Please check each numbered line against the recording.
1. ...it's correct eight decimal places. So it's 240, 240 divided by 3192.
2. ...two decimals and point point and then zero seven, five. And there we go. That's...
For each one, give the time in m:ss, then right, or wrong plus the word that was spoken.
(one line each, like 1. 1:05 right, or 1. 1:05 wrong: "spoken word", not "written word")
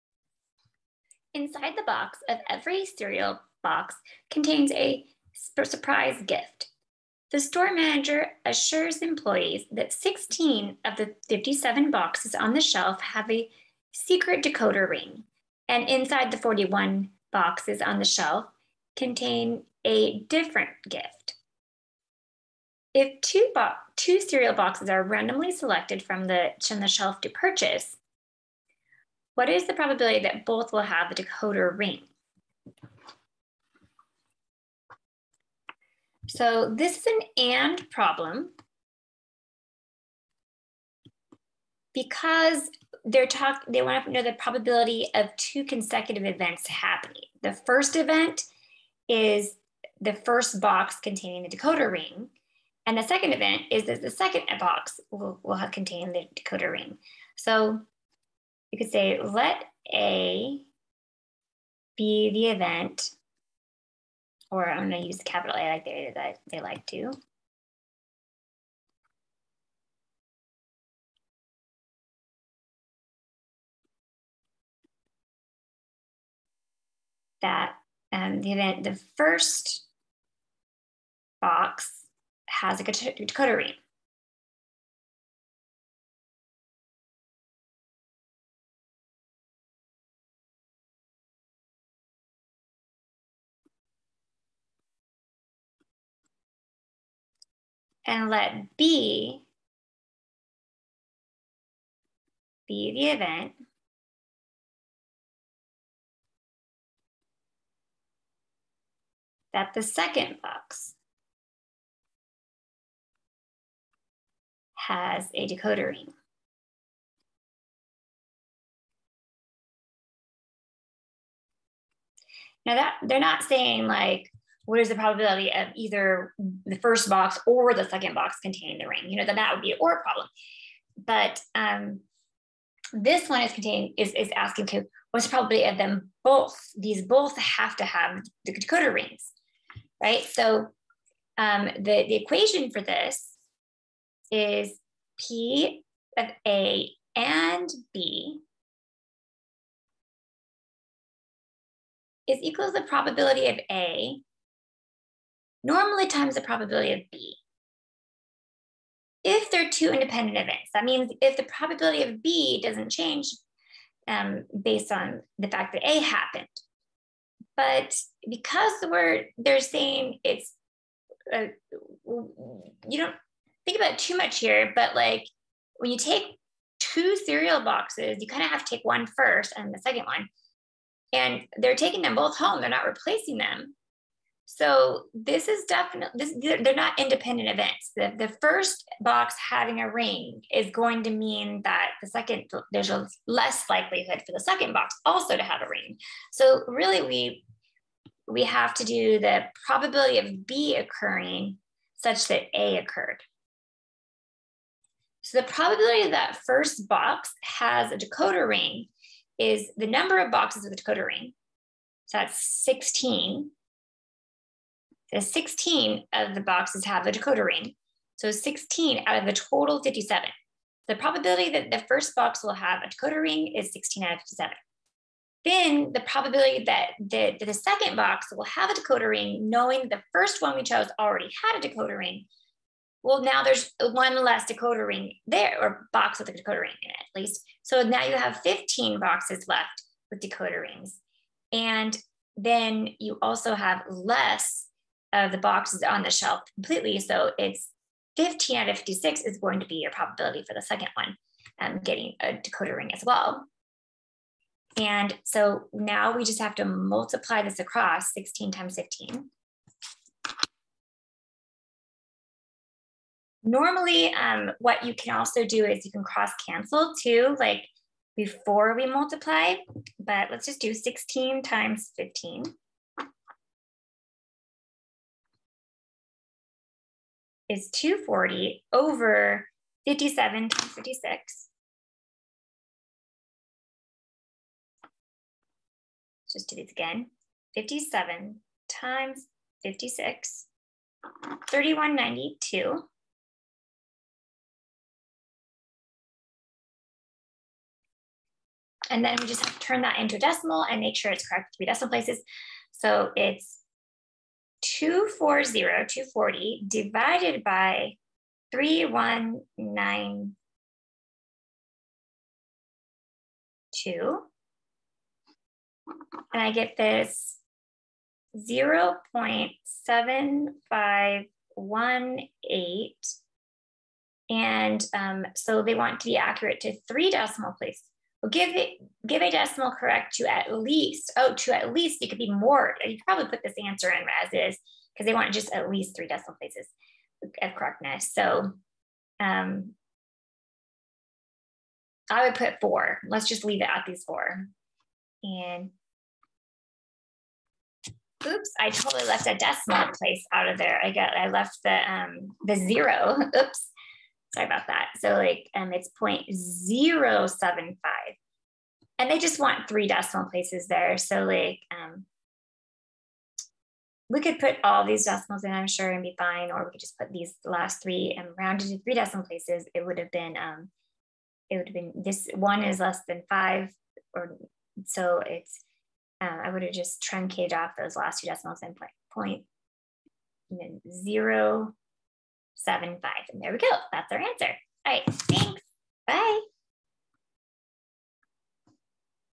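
1. 5:01 wrong: "three", not "eight"
2. 6:18 right.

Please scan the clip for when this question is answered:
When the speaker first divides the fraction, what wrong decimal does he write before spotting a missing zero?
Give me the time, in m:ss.
5:19.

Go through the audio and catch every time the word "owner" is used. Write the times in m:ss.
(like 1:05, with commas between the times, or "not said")
not said.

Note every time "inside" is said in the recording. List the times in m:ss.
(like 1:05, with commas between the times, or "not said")
0:01, 0:15.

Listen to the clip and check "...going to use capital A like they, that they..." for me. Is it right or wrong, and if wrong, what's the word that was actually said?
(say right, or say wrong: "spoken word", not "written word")
right.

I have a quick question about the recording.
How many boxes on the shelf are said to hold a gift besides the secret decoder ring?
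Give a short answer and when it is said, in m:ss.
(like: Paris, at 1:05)
41, at 0:16.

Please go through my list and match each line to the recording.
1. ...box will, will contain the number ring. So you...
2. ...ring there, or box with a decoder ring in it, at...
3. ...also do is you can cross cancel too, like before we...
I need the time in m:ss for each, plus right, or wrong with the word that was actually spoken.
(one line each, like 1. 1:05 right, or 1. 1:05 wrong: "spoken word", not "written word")
1. 0:54 wrong: "decoder", not "number"
2. 3:54 right
3. 4:25 right.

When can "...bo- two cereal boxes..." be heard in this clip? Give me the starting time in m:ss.
0:23.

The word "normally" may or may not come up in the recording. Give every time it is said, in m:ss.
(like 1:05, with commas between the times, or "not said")
2:35, 4:23.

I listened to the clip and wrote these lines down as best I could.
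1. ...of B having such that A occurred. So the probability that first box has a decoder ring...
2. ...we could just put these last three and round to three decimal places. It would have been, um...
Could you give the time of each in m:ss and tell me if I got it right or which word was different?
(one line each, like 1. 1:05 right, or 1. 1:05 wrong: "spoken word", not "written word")
1. 3:20 wrong: "occurring", not "having"
2. 6:06 right.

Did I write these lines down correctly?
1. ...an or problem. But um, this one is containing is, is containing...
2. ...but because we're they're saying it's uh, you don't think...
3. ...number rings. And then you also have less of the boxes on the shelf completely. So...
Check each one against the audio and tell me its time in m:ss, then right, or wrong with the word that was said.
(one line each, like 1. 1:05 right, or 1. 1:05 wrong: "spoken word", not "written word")
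1. 2:09 wrong: "asking", not "containing"
2. 2:47 right
3. 4:00 wrong: "decoder", not "number".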